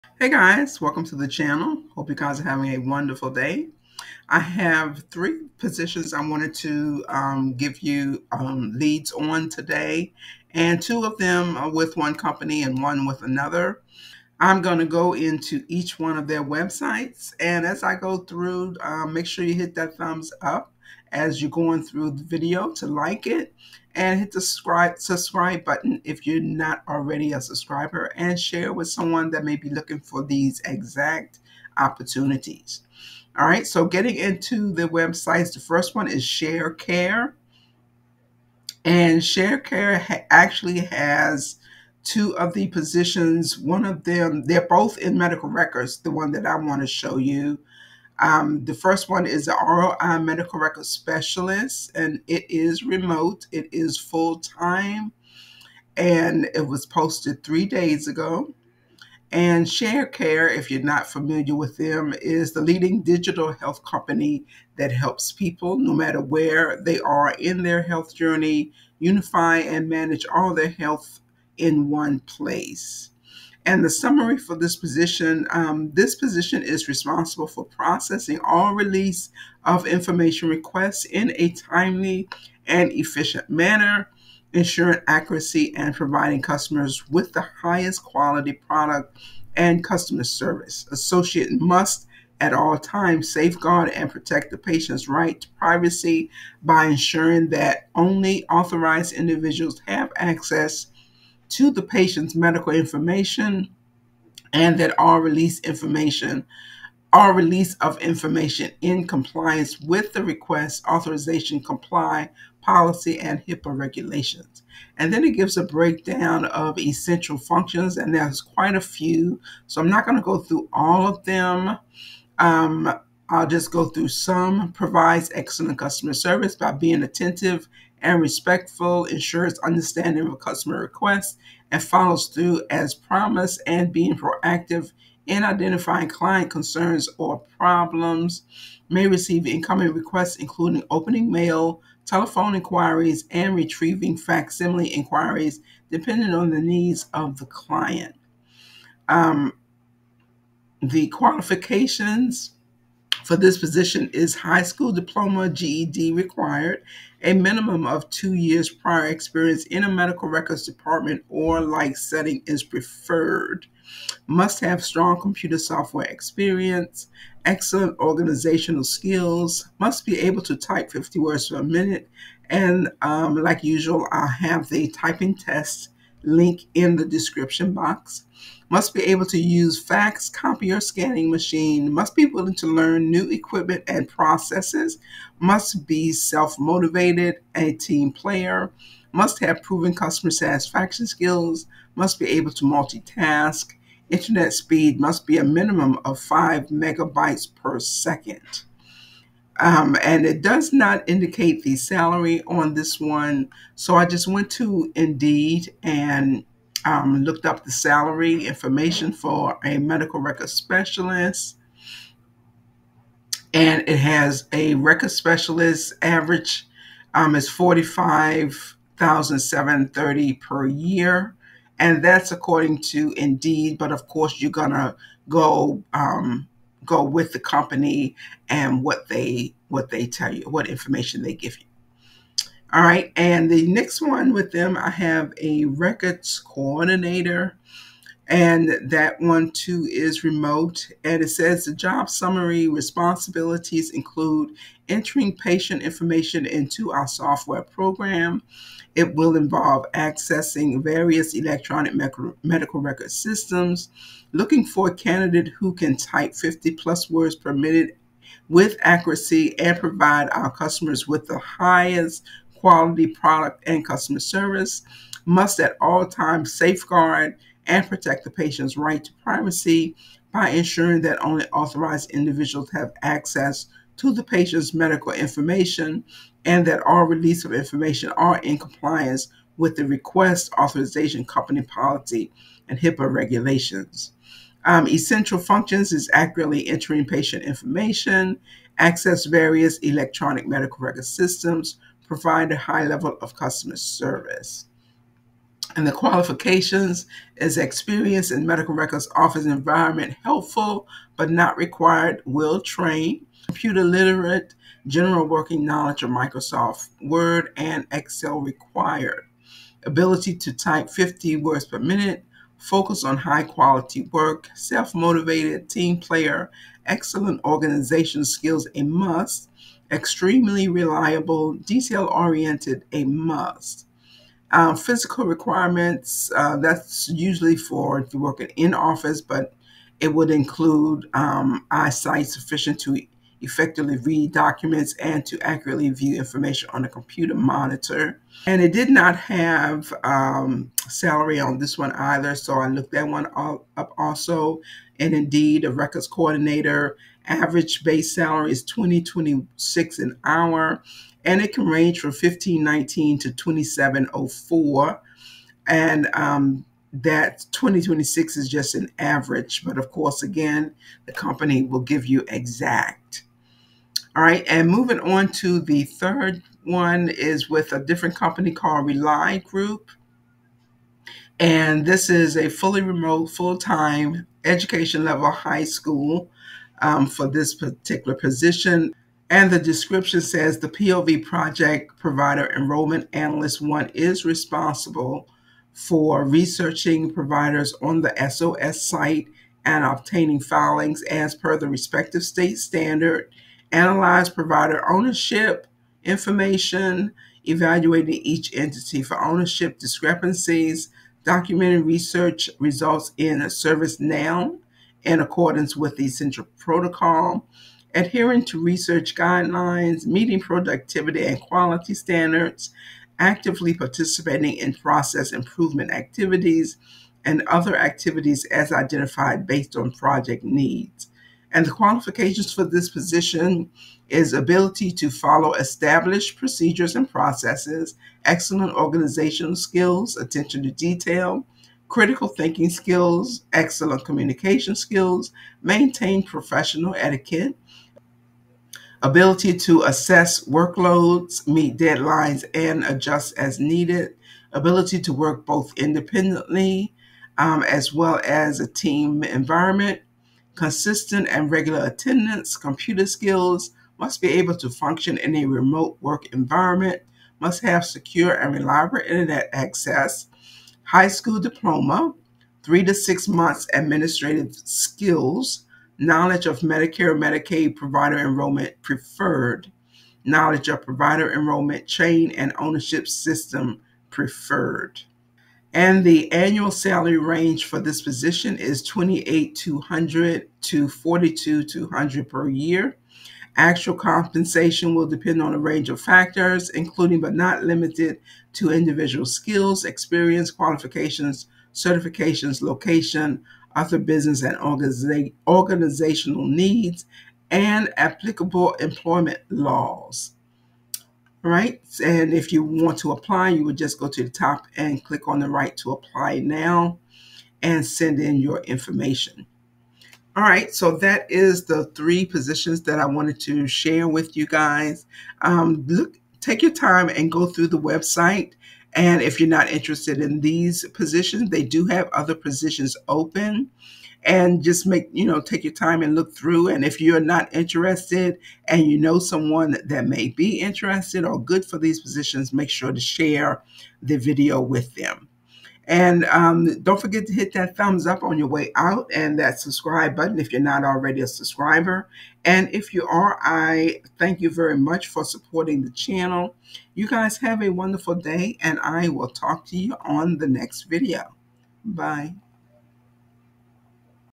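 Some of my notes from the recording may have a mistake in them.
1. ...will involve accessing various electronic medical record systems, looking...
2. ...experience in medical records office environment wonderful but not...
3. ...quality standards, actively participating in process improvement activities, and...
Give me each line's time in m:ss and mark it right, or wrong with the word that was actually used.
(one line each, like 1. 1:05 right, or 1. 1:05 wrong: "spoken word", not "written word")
1. 4:09 right
2. 4:57 wrong: "helpful", not "wonderful"
3. 6:51 right.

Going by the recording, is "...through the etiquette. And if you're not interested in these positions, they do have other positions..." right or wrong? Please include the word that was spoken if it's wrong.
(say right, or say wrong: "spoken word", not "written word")
wrong: "website", not "etiquette".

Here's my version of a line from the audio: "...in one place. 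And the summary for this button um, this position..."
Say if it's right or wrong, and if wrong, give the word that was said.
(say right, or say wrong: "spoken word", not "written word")
wrong: "position", not "button".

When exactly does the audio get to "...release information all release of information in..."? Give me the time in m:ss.
1:45.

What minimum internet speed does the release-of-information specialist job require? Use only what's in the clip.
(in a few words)
5 megabytes per second.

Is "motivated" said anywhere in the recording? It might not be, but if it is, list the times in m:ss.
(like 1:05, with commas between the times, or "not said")
3:06, 5:14.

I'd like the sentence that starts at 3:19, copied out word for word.
Um, and it does not indicate the salary on this one.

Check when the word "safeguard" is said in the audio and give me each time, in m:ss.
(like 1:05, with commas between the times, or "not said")
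1:33, 4:26.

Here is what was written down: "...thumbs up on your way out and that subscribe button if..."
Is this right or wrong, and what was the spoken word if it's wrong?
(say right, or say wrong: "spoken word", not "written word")
right.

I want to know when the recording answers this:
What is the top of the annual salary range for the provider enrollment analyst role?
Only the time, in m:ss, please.
8:00.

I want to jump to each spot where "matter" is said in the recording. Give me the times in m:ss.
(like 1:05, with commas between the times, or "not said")
1:05.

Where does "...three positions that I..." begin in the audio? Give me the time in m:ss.
8:31.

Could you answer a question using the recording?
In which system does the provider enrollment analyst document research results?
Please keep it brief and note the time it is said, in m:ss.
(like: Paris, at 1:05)
ServiceNow, at 6:43.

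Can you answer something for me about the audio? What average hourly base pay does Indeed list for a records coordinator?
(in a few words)
$20.26.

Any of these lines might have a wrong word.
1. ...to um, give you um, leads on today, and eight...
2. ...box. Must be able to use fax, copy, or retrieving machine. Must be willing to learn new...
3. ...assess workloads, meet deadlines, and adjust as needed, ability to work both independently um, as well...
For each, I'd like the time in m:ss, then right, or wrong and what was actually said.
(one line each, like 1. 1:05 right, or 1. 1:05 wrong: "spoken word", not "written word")
1. 0:06 wrong: "two", not "eight"
2. 2:57 wrong: "scanning", not "retrieving"
3. 7:19 right.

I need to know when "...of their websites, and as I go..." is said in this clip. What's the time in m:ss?
0:16.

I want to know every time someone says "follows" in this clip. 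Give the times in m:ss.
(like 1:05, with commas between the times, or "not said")
2:11, 7:05.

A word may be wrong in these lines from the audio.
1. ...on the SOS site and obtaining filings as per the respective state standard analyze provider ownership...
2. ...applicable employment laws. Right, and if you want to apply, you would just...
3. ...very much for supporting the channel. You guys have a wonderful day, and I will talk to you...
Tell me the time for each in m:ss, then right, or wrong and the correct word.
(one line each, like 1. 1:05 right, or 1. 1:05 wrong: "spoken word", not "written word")
1. 6:27 right
2. 8:17 right
3. 9:04 right.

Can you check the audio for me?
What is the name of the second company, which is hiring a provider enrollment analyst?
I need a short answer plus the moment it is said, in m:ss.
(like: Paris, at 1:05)
Reli Group, at 6:08.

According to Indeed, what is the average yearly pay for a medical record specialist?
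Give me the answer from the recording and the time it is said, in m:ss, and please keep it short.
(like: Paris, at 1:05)
$45,730, at 3:37.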